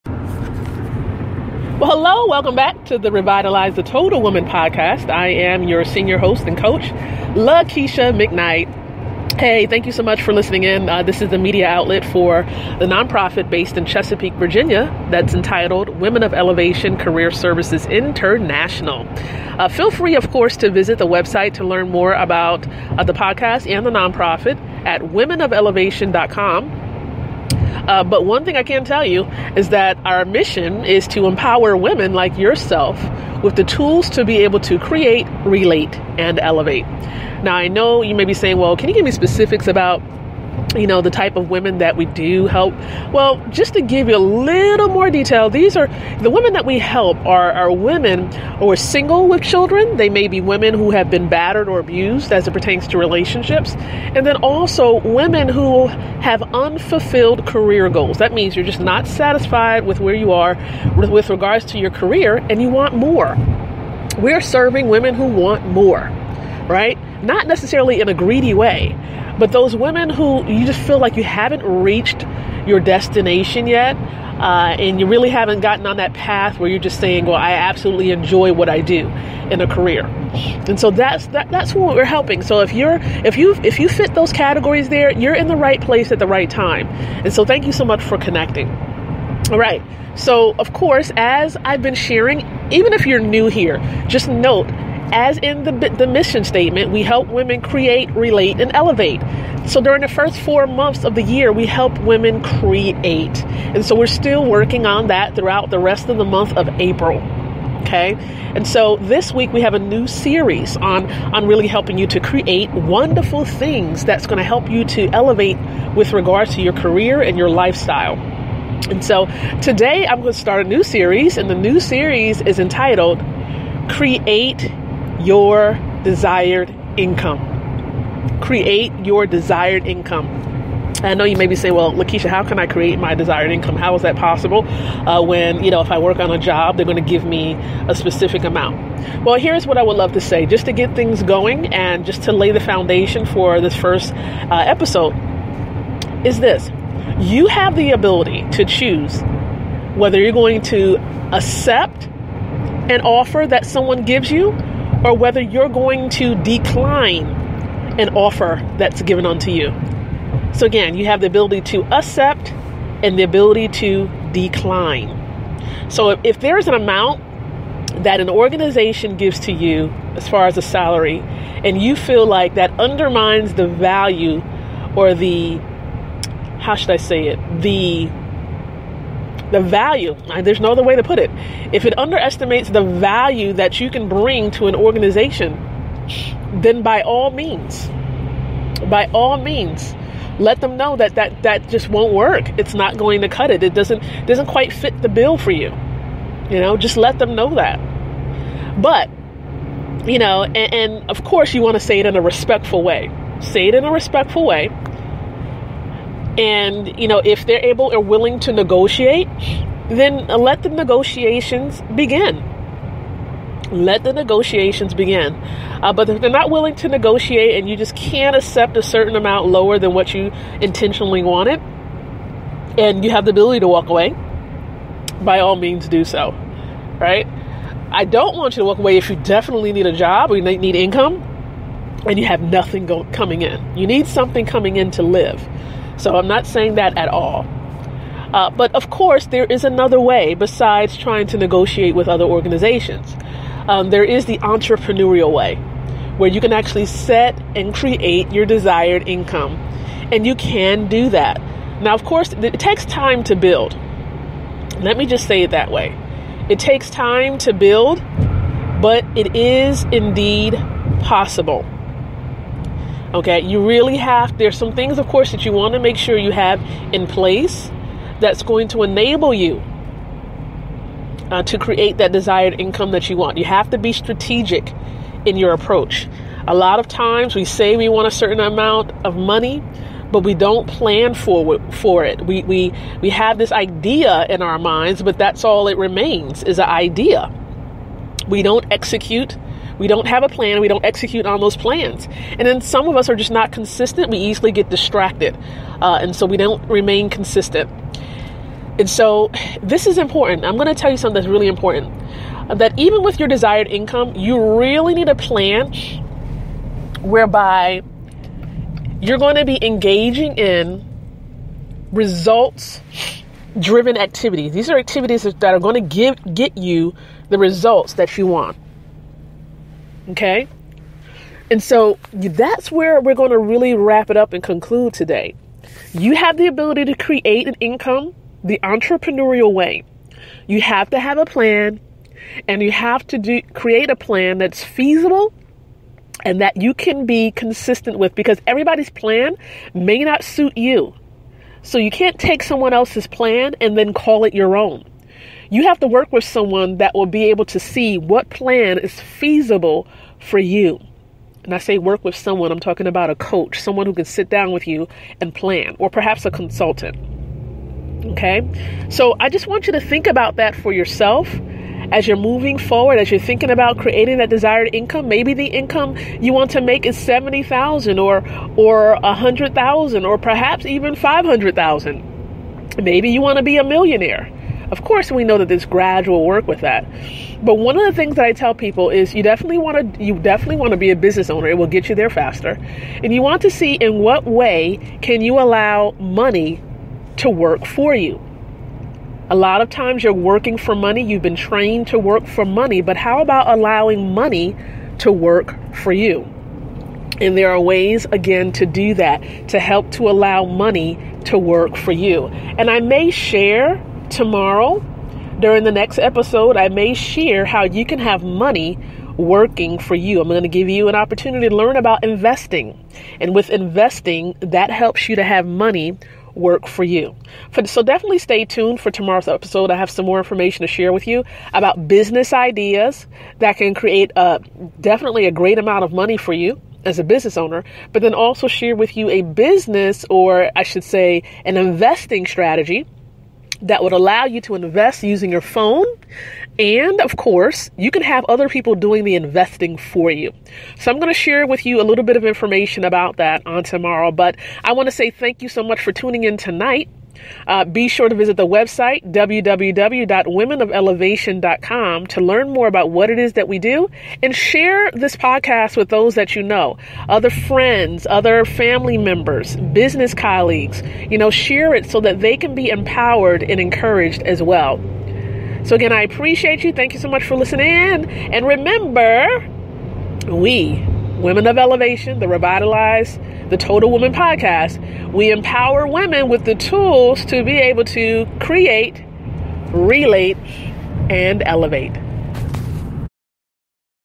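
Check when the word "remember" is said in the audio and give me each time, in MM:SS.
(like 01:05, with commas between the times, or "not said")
07:48.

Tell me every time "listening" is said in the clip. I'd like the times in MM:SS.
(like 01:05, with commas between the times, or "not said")
00:10, 07:47.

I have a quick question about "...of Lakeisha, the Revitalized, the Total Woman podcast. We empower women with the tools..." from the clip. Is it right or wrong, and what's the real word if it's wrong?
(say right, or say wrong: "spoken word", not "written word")
wrong: "Elevation", not "Lakeisha".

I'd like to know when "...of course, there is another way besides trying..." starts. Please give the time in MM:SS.
03:58.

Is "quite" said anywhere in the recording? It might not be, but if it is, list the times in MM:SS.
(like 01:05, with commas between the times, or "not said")
03:14.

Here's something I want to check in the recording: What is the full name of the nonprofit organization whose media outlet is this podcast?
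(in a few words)
Women of Elevation Career Services International.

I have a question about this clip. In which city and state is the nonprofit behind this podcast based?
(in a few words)
Chesapeake, Virginia.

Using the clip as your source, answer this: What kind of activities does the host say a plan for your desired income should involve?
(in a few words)
Results driven activities.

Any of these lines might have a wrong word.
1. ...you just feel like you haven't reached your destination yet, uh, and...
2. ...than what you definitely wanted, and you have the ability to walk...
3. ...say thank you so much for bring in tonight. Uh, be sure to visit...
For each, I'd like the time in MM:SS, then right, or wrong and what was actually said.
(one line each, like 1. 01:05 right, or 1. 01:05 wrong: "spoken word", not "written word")
1. 01:10 right
2. 03:39 wrong: "intentionally", not "definitely"
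3. 07:24 wrong: "tuning", not "bring".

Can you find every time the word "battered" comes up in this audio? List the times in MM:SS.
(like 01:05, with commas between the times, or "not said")
00:51.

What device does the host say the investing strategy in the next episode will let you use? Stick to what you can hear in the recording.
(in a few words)
Your phone.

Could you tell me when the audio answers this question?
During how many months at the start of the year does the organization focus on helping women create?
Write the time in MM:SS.
01:40.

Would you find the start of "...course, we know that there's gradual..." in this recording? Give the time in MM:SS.
06:14.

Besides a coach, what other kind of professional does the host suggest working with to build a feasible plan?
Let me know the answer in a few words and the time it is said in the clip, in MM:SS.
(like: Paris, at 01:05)
A consultant, at 05:56.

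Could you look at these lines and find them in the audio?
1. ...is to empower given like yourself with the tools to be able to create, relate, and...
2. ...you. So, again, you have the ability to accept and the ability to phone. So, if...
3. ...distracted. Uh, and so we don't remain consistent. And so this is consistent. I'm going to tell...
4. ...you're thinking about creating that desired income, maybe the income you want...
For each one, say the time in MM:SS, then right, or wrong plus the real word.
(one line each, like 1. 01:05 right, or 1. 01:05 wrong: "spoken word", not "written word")
1. 00:30 wrong: "women", not "given"
2. 02:39 wrong: "decline", not "phone"
3. 04:54 wrong: "important", not "consistent"
4. 06:03 right.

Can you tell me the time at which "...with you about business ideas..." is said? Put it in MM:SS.
07:00.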